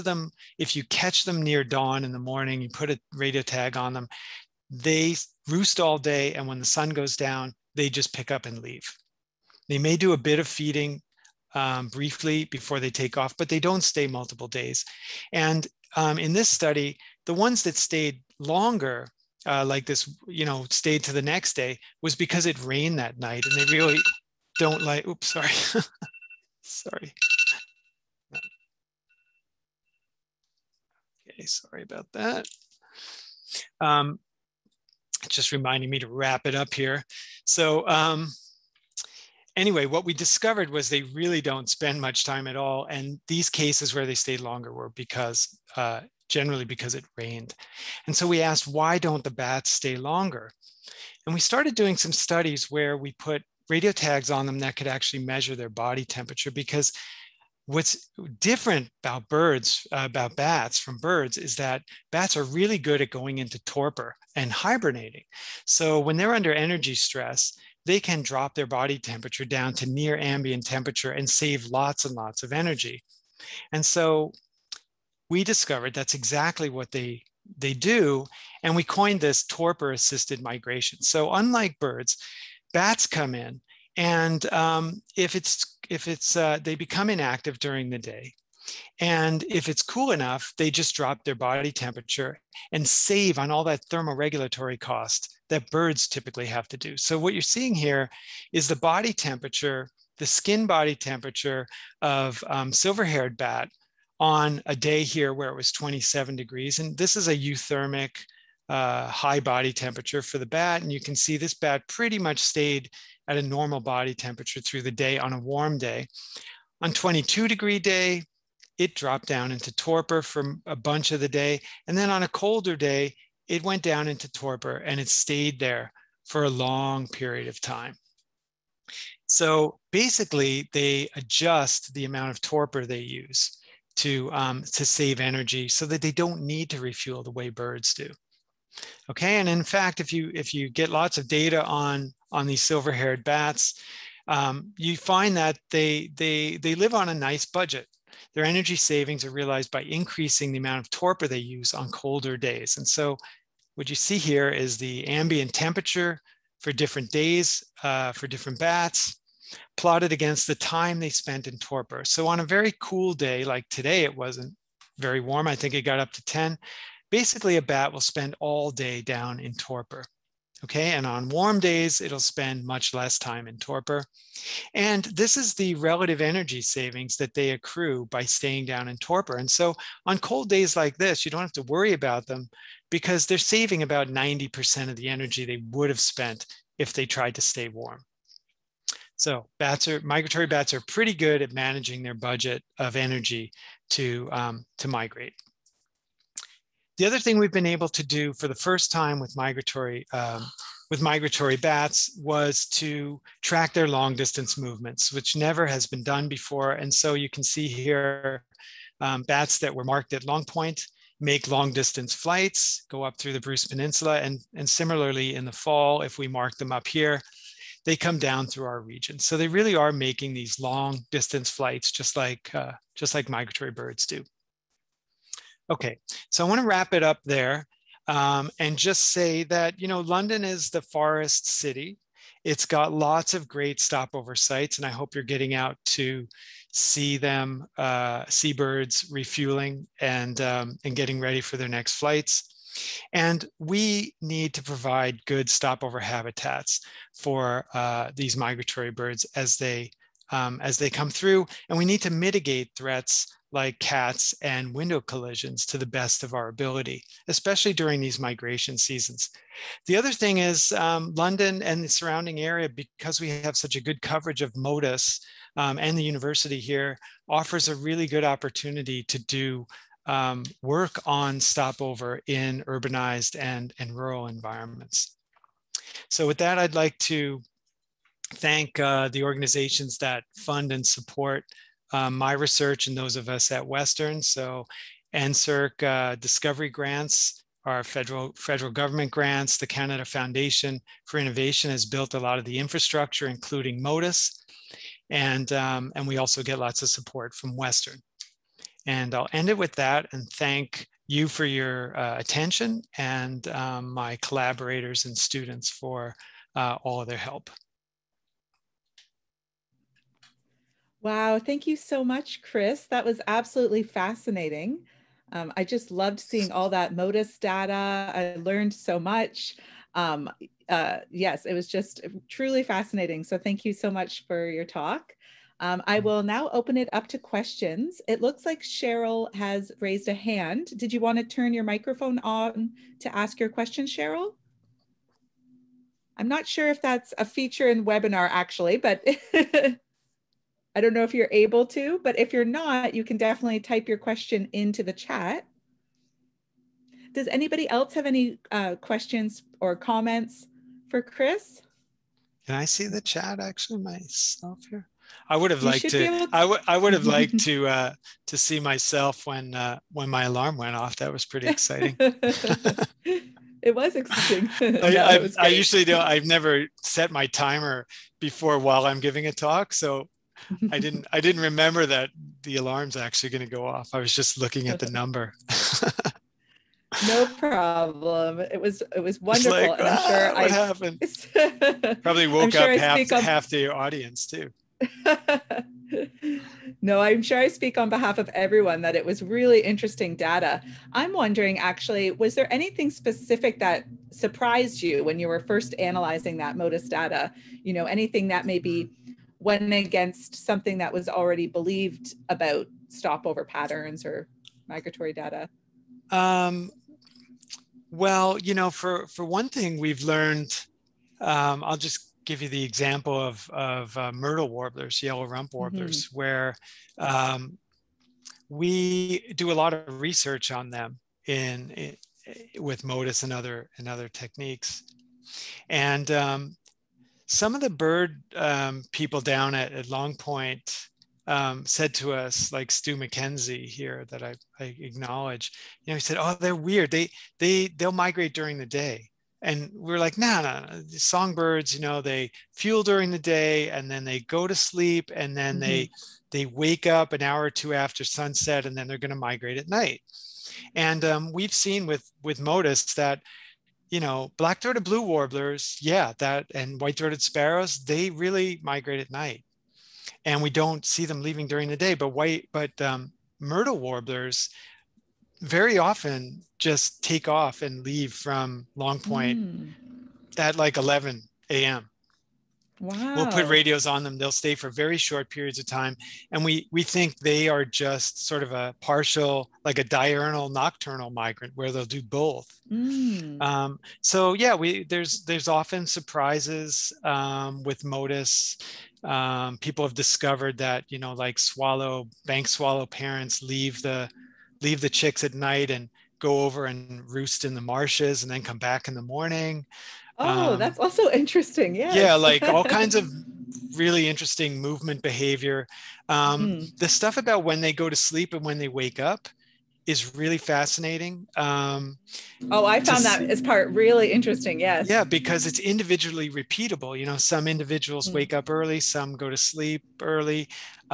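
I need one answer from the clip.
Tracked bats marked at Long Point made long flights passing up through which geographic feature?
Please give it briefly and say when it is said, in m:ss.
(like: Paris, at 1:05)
Bruce Peninsula, at 3:33.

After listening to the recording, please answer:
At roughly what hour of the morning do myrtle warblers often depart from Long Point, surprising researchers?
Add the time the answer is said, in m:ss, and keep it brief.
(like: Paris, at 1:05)
11 a.m., at 7:50.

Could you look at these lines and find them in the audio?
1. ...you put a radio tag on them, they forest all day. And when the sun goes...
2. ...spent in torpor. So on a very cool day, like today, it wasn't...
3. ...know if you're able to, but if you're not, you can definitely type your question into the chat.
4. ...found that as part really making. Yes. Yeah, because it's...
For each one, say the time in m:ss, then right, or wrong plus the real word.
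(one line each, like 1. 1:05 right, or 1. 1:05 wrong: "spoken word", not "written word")
1. 0:02 wrong: "roost", not "forest"
2. 2:41 right
3. 5:40 right
4. 8:32 wrong: "interesting", not "making".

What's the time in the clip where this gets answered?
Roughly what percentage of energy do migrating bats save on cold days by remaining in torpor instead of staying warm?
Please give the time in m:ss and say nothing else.
3:04.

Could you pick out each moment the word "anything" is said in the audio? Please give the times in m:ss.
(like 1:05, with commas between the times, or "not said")
6:32, 6:37.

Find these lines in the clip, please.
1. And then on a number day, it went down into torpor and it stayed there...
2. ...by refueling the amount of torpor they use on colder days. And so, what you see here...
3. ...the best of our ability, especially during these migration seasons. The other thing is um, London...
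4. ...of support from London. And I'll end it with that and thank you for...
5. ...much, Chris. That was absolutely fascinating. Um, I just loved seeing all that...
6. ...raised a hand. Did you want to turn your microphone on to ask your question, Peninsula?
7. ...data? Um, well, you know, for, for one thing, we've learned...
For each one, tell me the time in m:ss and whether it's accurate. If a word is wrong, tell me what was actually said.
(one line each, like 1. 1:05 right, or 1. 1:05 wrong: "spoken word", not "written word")
1. 2:01 wrong: "colder", not "number"
2. 2:29 wrong: "increasing", not "refueling"
3. 4:15 right
4. 4:56 wrong: "Western", not "London"
5. 5:12 right
6. 5:29 wrong: "Cheryl", not "Peninsula"
7. 6:45 right.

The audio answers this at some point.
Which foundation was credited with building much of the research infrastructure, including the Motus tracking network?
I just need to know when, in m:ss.
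4:49.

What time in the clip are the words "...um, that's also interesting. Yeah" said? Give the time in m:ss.
8:20.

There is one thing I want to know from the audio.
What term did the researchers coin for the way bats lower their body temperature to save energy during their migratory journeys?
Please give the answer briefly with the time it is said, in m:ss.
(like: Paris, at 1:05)
torpor assisted migration, at 1:19.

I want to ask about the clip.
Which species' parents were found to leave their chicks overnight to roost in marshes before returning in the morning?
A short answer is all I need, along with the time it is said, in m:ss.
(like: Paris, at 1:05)
bank swallow, at 8:12.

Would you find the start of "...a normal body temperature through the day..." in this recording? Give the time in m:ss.
1:53.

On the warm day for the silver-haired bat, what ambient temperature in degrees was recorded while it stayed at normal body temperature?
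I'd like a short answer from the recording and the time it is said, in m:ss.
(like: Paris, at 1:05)
27, at 1:45.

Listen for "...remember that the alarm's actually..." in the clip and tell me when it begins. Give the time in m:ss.
6:11.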